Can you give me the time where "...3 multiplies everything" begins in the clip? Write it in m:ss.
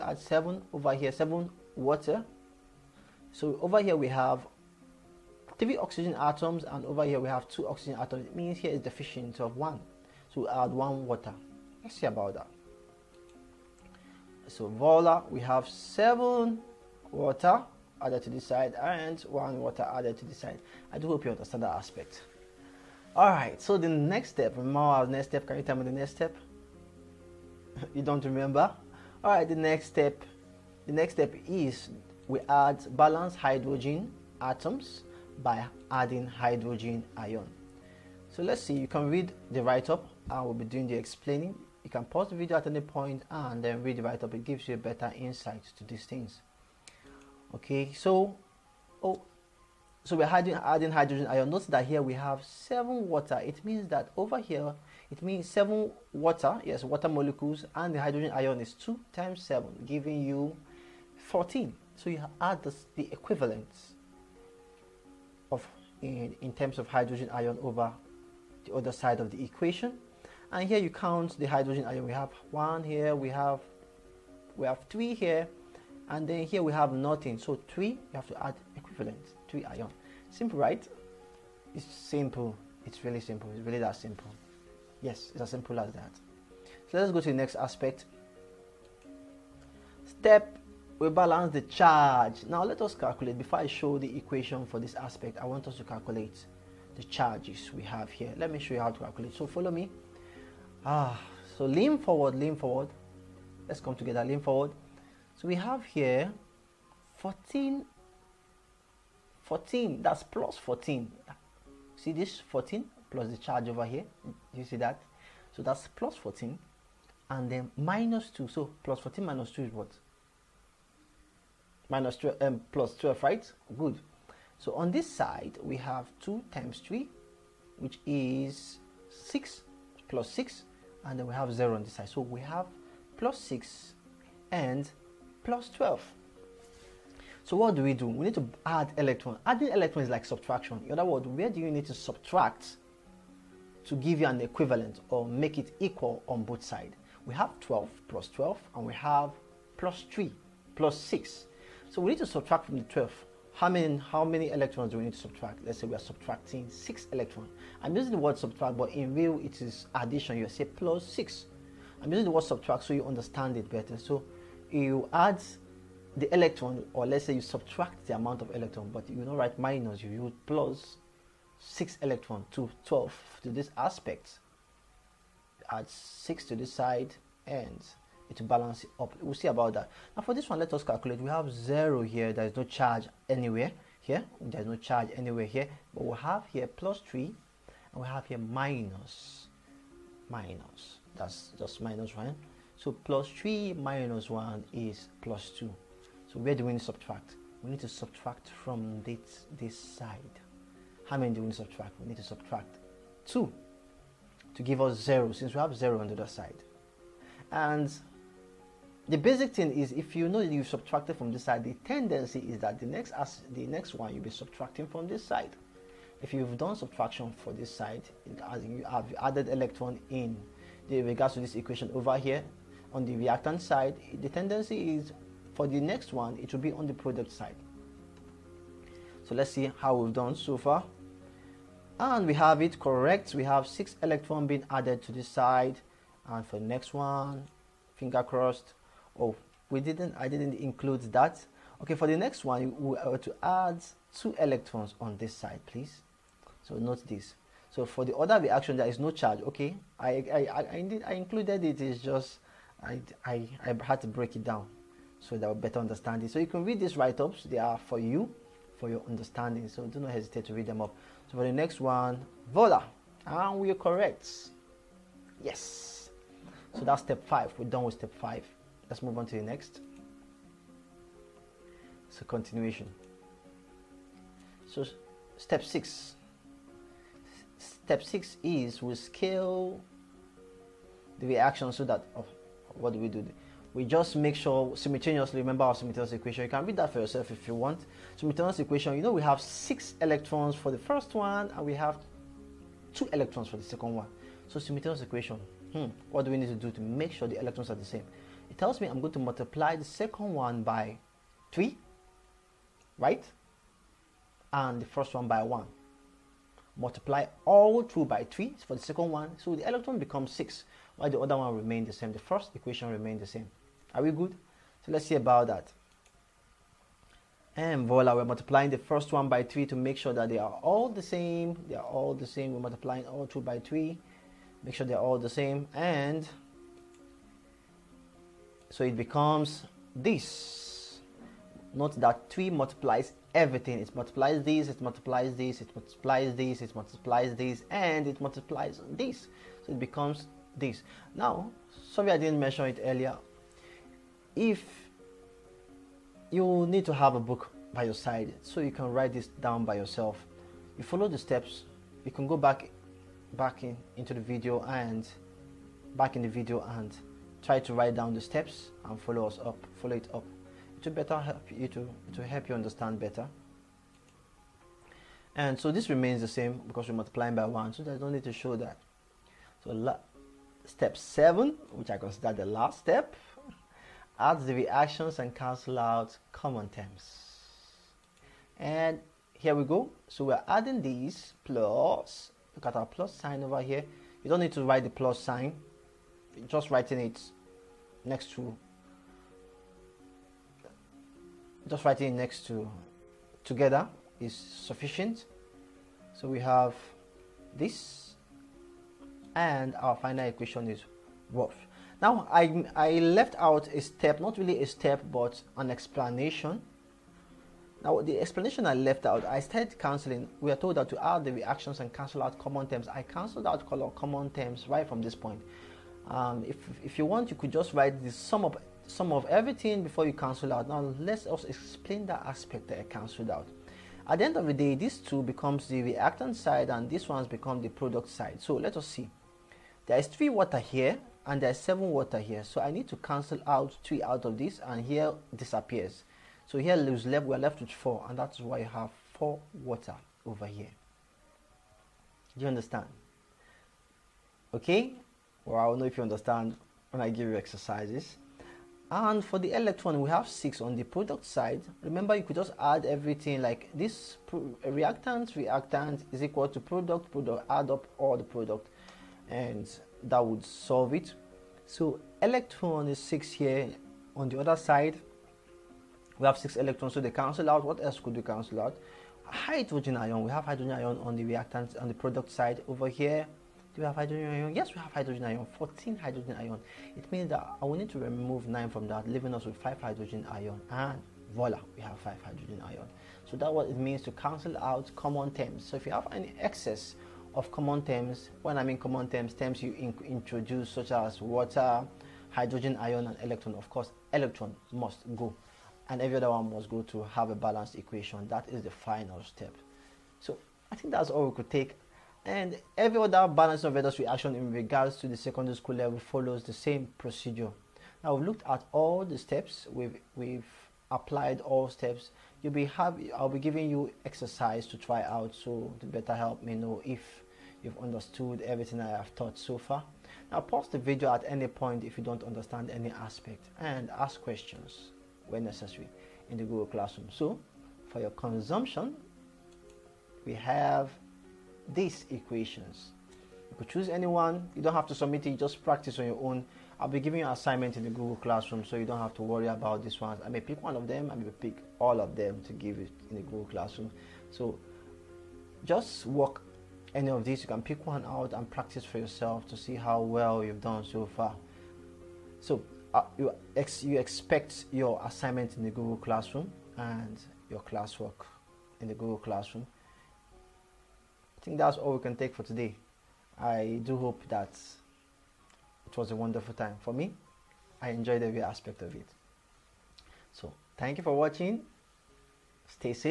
5:32.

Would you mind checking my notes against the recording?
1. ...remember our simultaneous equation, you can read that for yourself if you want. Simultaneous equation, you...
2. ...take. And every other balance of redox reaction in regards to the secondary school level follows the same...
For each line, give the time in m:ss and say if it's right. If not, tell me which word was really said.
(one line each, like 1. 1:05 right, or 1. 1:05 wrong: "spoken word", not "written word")
1. 4:45 right
2. 8:21 right.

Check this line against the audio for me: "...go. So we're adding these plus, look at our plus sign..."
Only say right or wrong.
right.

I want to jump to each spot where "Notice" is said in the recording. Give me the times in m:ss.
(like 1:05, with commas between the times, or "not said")
0:51.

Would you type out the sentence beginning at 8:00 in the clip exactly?
And voila, we have 5 hydrogen ion.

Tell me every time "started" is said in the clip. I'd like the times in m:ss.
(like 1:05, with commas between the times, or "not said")
6:49.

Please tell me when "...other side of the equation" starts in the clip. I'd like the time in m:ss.
1:08.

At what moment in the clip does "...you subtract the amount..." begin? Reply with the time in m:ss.
2:47.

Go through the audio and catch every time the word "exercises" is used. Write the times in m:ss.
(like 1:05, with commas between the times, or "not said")
7:27, 8:34.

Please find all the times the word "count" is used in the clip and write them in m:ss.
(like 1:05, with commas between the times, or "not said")
1:10.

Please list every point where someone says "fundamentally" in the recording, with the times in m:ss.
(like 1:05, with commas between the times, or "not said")
not said.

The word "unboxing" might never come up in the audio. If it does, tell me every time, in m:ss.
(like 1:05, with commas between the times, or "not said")
not said.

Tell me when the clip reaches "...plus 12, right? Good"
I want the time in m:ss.
2:02.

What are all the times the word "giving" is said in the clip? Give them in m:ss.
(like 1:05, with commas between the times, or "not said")
0:59, 8:33, 8:56.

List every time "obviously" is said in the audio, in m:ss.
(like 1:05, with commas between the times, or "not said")
not said.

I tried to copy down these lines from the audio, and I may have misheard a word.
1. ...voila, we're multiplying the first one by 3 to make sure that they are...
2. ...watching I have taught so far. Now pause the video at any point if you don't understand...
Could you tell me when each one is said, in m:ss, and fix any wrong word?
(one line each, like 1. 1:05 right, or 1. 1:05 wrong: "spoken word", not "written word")
1. 5:17 right
2. 8:38 wrong: "everything", not "watching".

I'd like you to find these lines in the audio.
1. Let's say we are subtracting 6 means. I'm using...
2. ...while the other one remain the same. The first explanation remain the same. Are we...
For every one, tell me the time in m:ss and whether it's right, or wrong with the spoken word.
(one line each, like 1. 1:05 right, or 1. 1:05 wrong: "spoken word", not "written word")
1. 2:35 wrong: "electrons", not "means"
2. 5:10 wrong: "equation", not "explanation".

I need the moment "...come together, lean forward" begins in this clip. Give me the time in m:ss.
1:43.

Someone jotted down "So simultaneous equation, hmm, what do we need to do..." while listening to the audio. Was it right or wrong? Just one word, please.
right.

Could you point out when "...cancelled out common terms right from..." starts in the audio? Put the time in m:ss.
6:53.